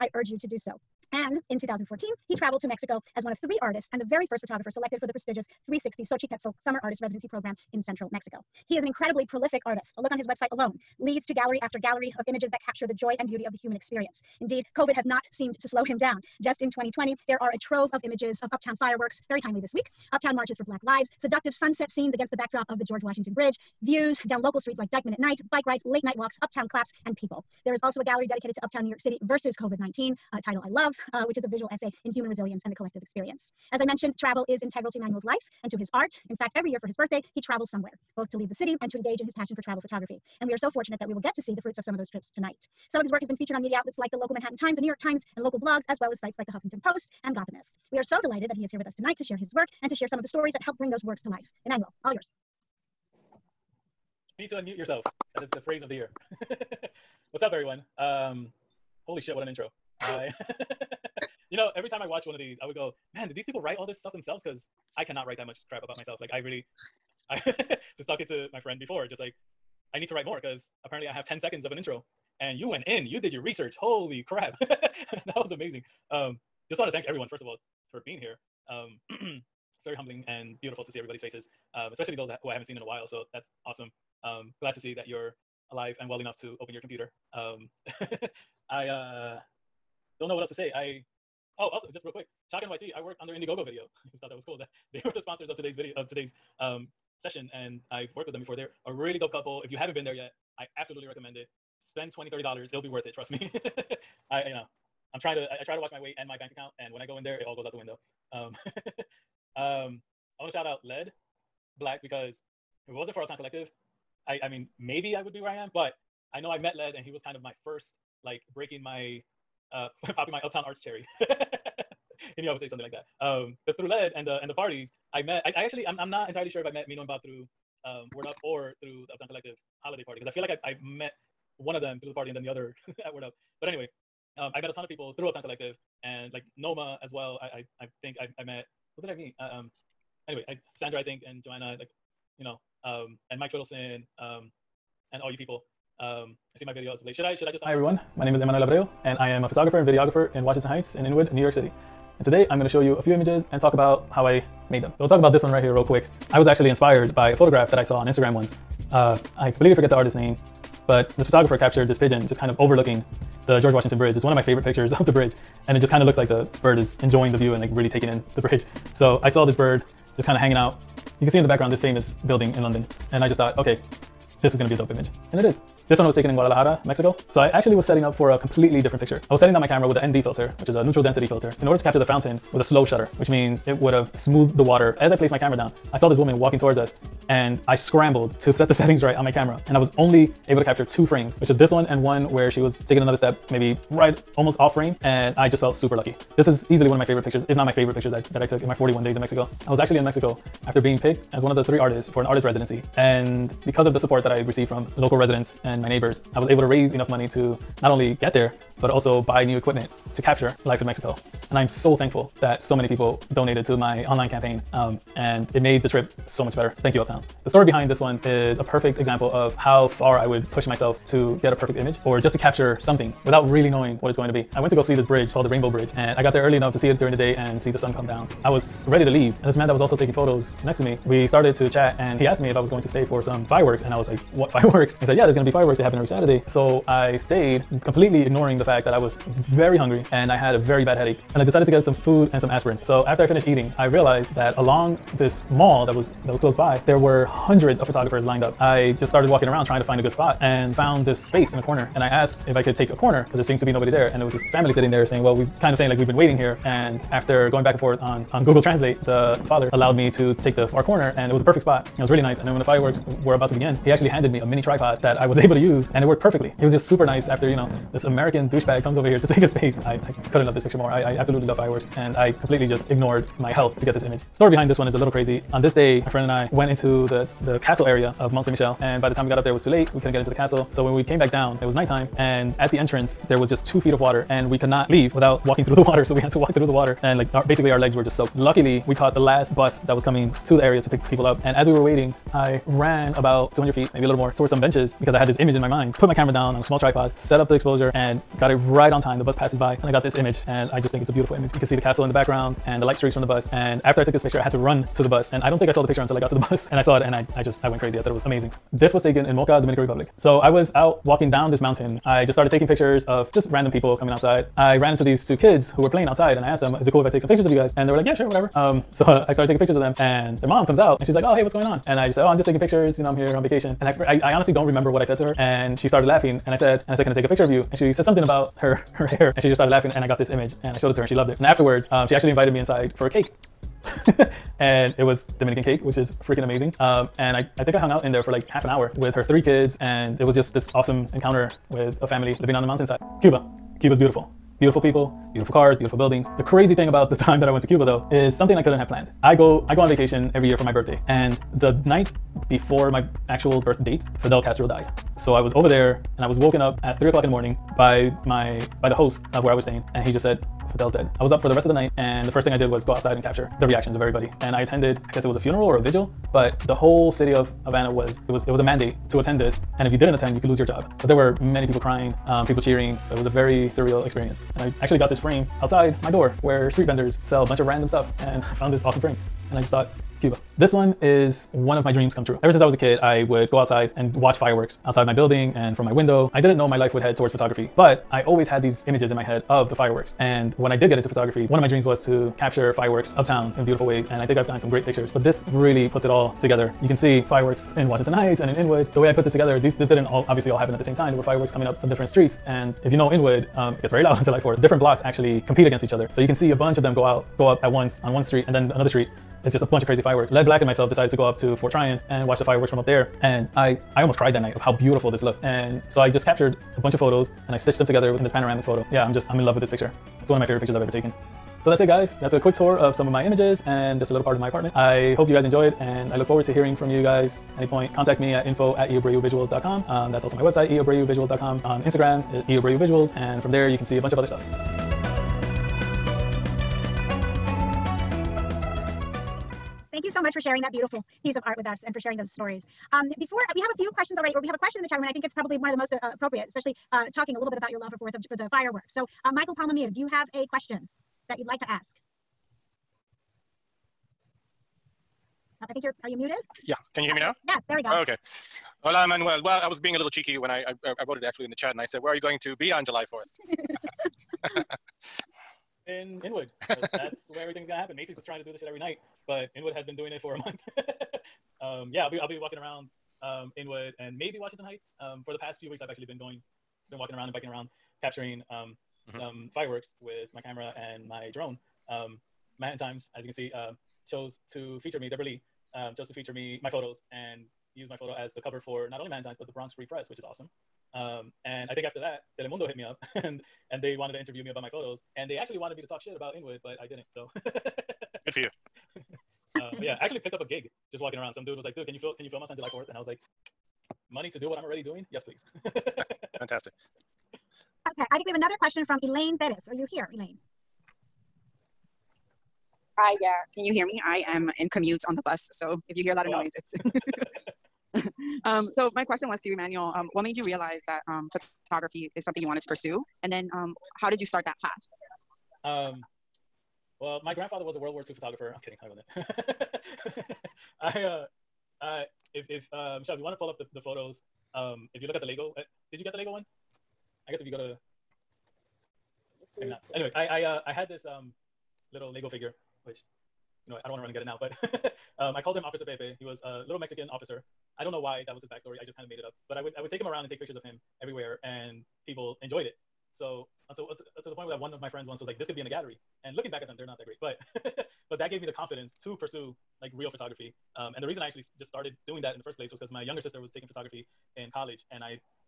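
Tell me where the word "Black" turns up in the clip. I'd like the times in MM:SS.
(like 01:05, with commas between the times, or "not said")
00:20, 01:51, 06:50.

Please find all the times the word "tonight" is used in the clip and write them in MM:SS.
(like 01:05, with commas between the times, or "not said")
00:42, 00:48.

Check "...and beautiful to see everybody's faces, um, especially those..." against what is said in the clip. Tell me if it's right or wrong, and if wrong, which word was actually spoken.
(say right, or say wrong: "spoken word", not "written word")
right.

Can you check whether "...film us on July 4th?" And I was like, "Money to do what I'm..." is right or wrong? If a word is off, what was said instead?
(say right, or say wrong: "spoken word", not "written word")
right.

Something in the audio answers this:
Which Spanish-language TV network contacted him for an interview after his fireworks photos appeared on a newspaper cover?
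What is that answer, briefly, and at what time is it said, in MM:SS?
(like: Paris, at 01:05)
Telemundo, at 08:12.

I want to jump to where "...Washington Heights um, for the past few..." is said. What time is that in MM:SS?
07:54.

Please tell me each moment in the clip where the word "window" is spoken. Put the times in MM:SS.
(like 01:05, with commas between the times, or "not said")
01:47, 06:25.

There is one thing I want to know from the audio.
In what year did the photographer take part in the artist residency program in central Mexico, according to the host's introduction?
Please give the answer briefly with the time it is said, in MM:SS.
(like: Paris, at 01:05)
2014, at 00:01.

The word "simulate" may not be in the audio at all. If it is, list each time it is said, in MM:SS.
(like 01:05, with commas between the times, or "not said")
not said.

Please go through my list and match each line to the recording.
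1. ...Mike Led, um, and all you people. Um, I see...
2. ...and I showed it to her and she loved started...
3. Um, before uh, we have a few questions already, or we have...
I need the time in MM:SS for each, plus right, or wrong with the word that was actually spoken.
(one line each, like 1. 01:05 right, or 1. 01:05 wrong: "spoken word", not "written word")
1. 02:23 wrong: "Fiddleston", not "Led"
2. 05:30 wrong: "loved", not "started"
3. 07:22 right.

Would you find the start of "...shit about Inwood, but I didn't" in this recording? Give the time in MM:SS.
08:16.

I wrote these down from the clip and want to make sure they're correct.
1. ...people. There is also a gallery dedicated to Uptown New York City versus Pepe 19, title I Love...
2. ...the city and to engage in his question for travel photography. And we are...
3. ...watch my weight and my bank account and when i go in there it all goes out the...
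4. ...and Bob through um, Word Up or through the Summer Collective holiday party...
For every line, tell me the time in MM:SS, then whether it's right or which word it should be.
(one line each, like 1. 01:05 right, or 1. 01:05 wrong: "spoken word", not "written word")
1. 00:27 wrong: "COVID", not "Pepe"
2. 00:38 wrong: "passion", not "question"
3. 01:45 right
4. 02:07 wrong: "Uptown", not "Summer".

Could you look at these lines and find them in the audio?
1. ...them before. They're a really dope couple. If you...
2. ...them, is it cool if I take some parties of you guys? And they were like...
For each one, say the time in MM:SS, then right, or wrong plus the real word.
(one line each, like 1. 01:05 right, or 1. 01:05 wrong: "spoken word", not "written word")
1. 01:38 right
2. 05:16 wrong: "pictures", not "parties".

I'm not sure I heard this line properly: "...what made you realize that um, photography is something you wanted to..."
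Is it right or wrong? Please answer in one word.
right.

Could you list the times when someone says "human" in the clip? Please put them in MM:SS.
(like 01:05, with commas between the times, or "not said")
00:13, 00:32.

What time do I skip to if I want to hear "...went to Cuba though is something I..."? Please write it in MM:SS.
05:47.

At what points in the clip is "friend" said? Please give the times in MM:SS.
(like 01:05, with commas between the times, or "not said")
01:08, 04:36, 09:14.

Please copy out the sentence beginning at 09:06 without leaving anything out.
He was a little Mexican officer.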